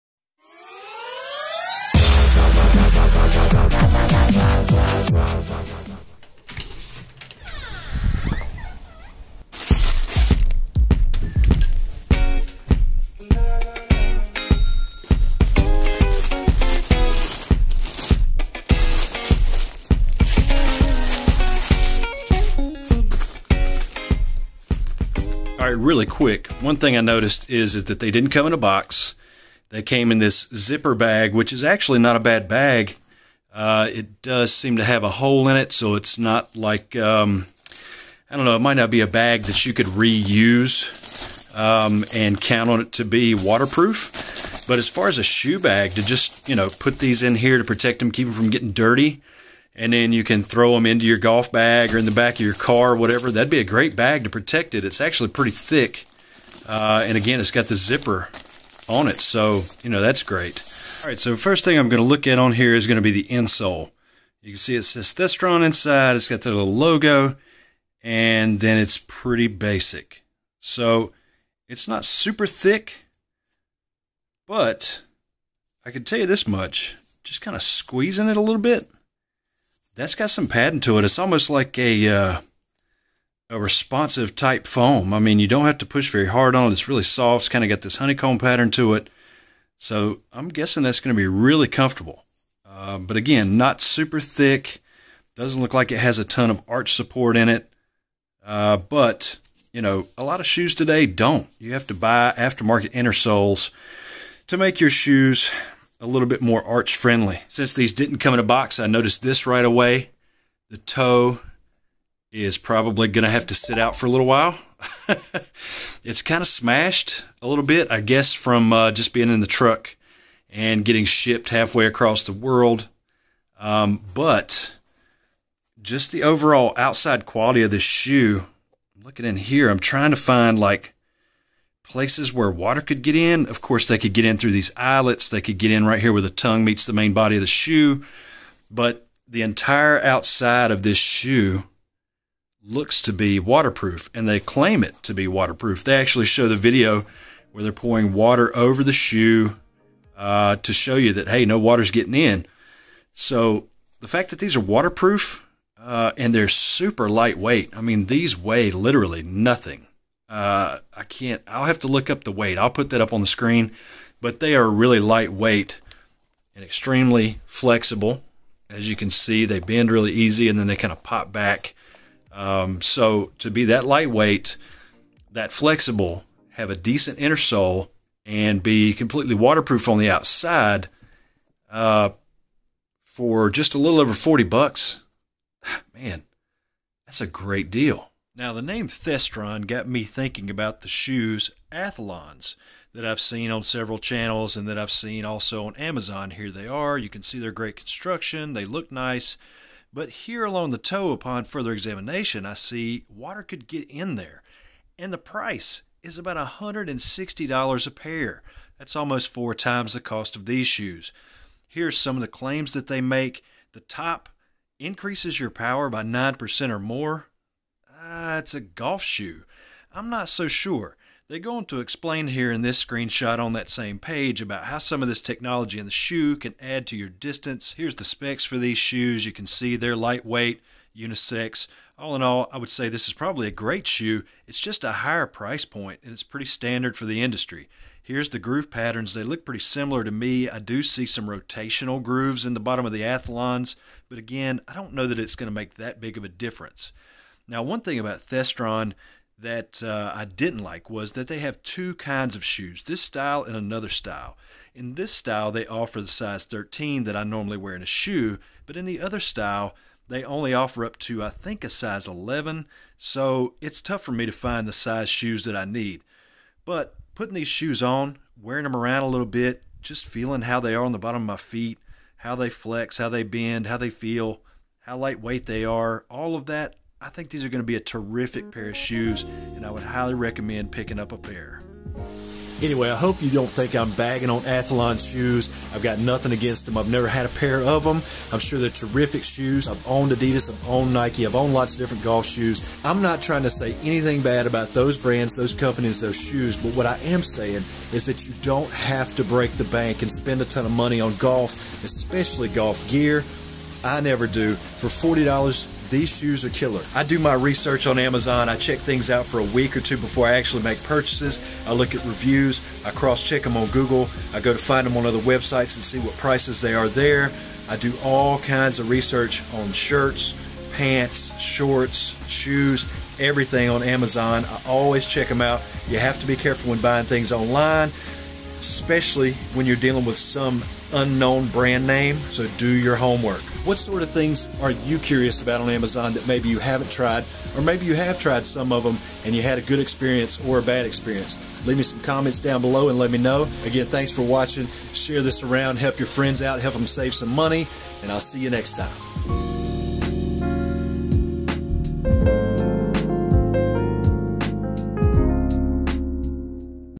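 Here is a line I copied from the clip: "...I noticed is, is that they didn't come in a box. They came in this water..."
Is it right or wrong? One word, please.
wrong.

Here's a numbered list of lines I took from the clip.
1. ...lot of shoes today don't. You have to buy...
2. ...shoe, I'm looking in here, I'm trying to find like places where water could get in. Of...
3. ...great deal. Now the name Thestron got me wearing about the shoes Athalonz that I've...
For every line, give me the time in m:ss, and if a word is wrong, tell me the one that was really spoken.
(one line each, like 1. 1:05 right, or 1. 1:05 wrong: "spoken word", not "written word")
1. 1:40 right
2. 2:07 right
3. 3:07 wrong: "thinking", not "wearing".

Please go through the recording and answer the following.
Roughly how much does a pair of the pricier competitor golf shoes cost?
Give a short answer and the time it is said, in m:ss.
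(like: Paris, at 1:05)
$160, at 3:26.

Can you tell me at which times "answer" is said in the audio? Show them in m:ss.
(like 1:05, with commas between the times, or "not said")
not said.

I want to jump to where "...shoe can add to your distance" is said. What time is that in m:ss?
3:45.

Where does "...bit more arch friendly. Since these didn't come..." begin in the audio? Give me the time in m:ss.
1:46.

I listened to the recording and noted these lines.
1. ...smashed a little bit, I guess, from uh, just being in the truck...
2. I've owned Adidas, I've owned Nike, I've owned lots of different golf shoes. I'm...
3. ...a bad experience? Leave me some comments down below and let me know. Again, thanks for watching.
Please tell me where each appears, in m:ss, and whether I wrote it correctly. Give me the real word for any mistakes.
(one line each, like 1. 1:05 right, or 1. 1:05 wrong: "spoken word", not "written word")
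1. 1:56 right
2. 4:49 right
3. 5:40 right.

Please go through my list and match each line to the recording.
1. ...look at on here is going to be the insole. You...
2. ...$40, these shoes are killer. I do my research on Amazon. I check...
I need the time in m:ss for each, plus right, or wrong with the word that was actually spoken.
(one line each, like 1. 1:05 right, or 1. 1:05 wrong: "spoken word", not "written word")
1. 1:02 right
2. 5:04 right.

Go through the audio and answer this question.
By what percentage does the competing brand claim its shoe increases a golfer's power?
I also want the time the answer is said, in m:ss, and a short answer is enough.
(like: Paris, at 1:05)
9%, at 3:36.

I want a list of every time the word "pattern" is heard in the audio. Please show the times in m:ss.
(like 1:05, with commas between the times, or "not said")
1:28, 3:58.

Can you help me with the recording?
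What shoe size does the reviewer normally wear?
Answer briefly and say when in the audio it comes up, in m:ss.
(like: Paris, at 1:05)
13, at 4:16.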